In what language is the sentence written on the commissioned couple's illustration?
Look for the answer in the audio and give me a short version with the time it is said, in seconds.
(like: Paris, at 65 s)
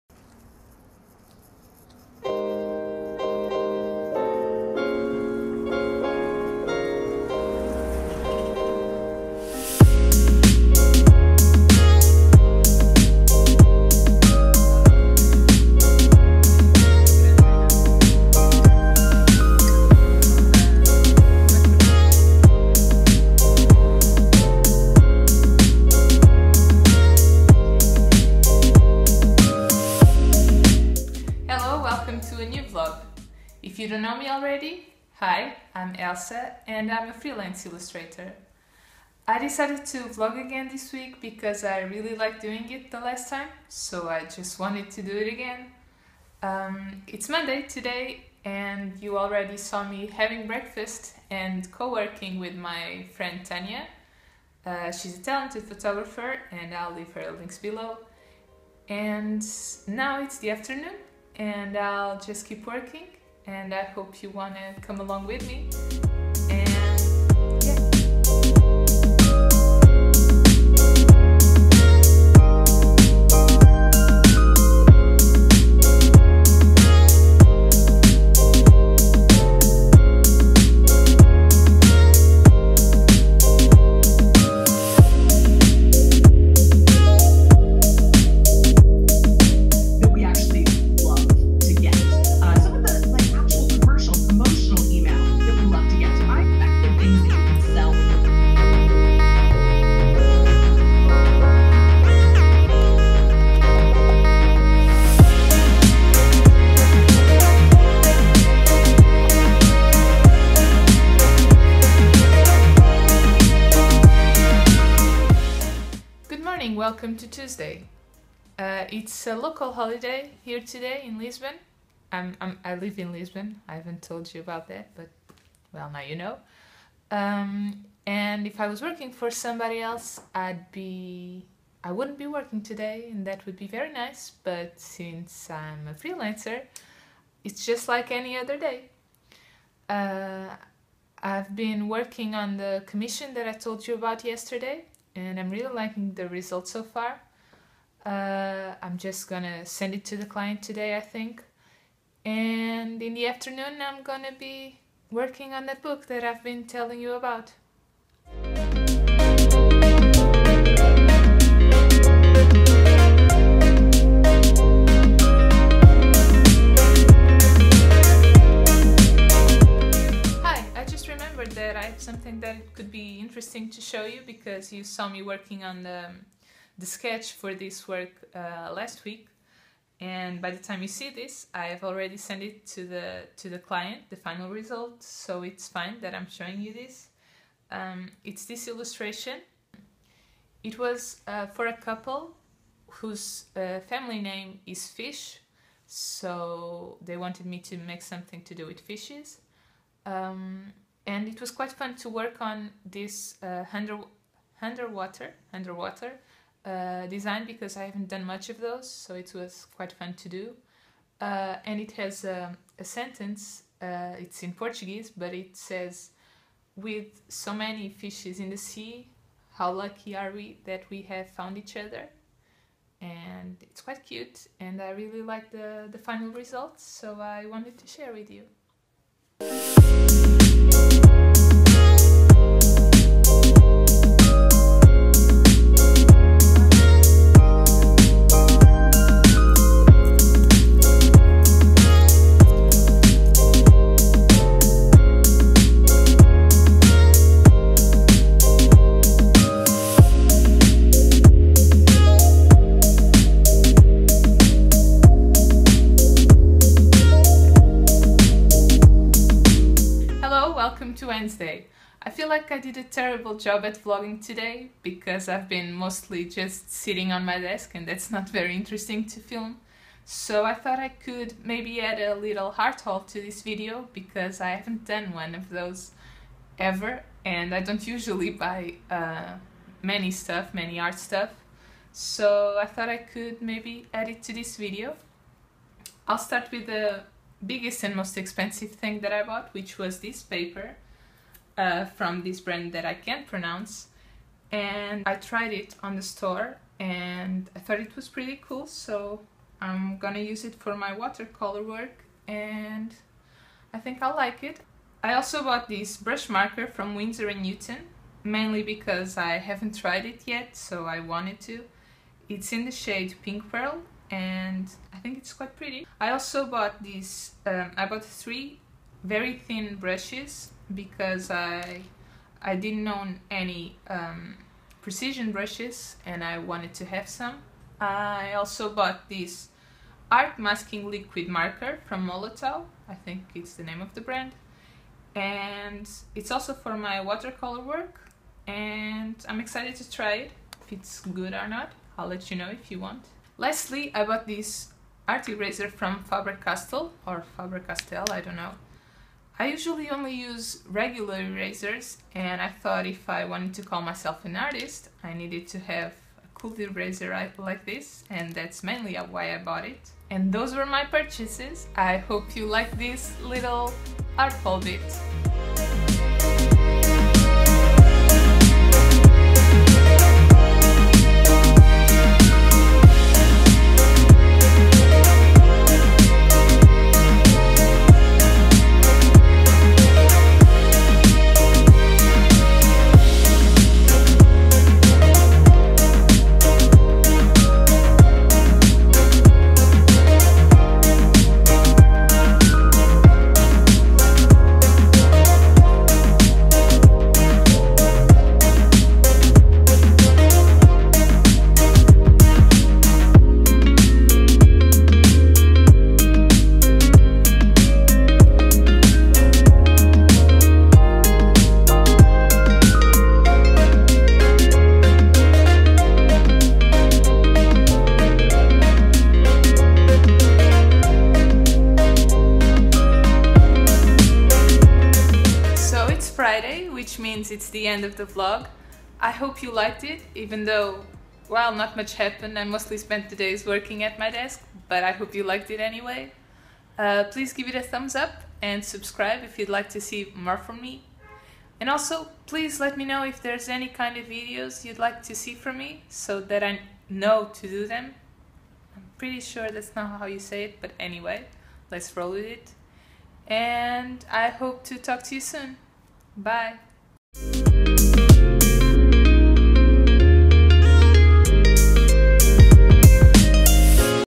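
Portuguese, at 214 s.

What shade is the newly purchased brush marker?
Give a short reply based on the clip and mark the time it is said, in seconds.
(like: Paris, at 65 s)
Pink Pearl, at 313 s.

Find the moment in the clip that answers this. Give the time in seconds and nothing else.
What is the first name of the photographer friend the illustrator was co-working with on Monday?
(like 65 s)
53 s.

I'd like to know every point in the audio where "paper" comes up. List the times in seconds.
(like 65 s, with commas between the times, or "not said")
290 s.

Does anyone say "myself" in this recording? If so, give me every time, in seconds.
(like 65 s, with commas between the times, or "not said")
353 s.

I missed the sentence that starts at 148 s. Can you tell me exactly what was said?
Uh, I'm just gonna send it to the client today, I think.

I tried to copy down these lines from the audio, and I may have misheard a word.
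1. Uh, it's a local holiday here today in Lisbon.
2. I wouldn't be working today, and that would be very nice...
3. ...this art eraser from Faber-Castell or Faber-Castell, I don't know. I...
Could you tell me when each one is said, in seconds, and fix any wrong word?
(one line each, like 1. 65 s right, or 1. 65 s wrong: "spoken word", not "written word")
1. 118 s right
2. 131 s right
3. 344 s right.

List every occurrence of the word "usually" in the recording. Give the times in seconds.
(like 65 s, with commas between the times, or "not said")
277 s, 349 s.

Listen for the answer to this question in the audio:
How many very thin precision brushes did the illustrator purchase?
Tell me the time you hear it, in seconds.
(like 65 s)
318 s.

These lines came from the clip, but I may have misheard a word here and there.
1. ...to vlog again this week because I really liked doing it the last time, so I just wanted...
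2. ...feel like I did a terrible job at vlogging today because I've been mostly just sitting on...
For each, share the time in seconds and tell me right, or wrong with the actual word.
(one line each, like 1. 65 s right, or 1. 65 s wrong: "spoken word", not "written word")
1. 39 s right
2. 262 s right.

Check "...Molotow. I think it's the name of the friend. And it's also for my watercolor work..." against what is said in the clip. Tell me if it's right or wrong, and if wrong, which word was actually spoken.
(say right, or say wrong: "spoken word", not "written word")
wrong: "brand", not "friend".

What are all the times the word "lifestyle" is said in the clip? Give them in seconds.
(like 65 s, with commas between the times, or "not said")
not said.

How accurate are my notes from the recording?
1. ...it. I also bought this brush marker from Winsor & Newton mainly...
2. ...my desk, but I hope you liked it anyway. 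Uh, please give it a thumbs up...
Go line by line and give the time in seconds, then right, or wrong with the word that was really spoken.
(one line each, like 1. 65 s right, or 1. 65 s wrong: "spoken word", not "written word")
1. 304 s right
2. 433 s right.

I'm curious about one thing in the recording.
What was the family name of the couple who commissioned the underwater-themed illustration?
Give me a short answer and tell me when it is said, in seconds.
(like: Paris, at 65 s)
Fish, at 194 s.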